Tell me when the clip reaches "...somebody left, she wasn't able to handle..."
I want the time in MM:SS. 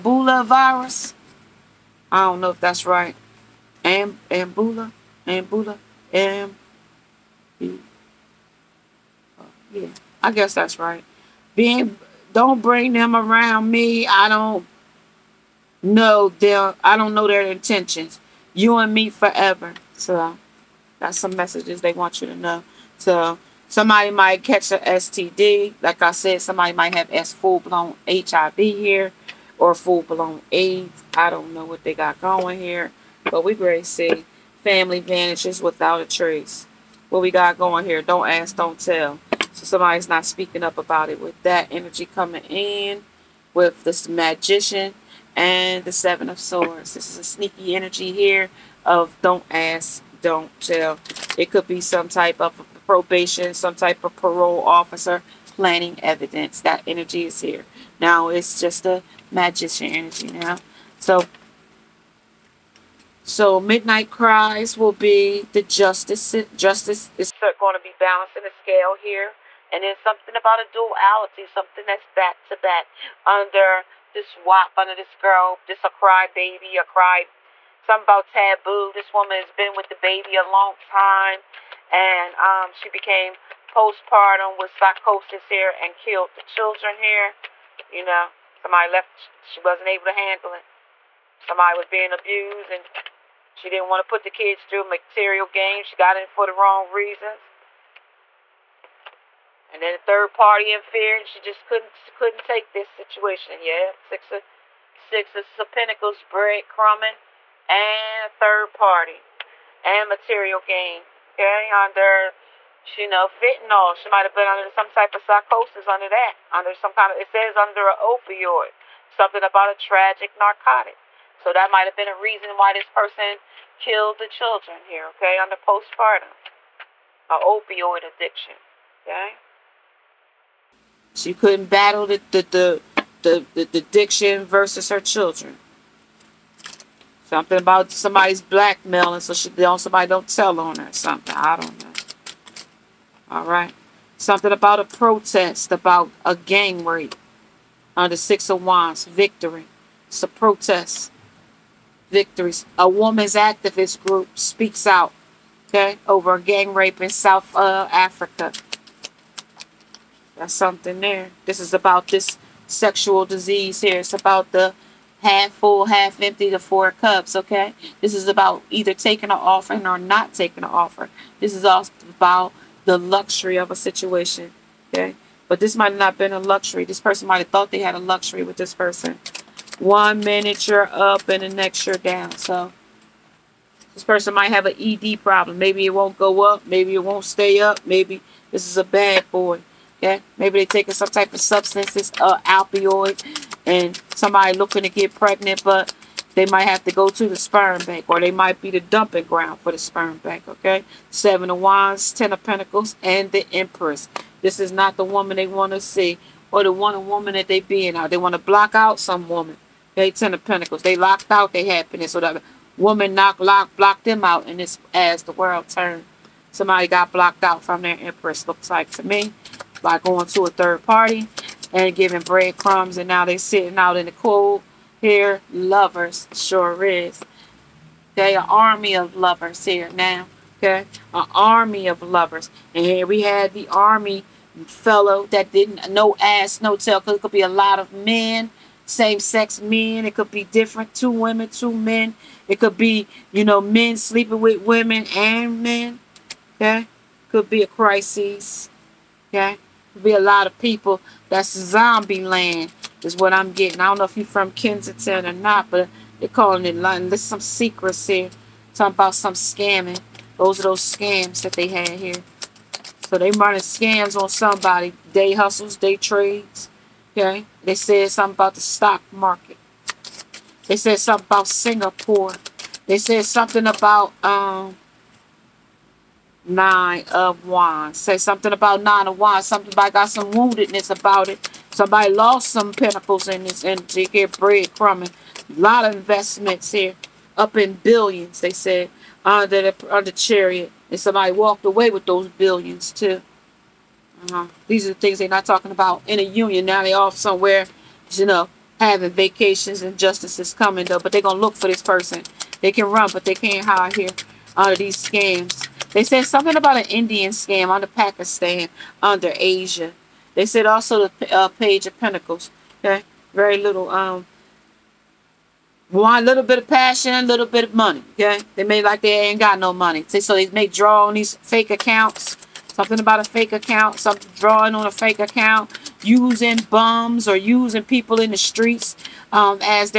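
01:28.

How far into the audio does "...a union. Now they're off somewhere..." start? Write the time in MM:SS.
04:56.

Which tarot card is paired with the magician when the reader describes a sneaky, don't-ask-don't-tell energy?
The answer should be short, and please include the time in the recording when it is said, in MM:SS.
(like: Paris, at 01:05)
Seven of Swords, at 00:45.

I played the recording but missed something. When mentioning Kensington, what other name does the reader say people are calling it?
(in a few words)
London.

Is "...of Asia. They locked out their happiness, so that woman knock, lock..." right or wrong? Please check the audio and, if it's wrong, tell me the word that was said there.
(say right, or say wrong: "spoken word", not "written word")
wrong: "Pentacles", not "Asia".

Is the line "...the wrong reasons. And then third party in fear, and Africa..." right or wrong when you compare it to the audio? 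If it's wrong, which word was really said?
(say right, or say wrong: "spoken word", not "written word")
wrong: "She", not "Africa".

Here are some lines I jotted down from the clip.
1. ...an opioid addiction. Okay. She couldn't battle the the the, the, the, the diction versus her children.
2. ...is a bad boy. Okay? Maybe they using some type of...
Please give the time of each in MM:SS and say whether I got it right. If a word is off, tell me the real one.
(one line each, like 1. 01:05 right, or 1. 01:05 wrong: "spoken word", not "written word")
1. 02:07 right
2. 03:08 wrong: "taking", not "using".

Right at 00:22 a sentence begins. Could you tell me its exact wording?
So somebody might catch a STD.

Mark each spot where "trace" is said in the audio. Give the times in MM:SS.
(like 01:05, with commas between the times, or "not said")
00:36.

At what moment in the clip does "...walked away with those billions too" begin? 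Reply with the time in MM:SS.
04:51.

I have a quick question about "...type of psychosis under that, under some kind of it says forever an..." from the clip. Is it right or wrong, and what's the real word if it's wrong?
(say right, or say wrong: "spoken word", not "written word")
wrong: "under", not "forever".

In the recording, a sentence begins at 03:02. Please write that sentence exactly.
So this person might have an ED problem.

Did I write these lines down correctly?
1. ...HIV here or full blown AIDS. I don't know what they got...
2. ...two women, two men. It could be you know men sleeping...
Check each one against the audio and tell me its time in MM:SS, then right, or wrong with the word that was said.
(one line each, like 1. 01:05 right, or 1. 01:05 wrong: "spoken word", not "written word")
1. 00:28 right
2. 04:00 right.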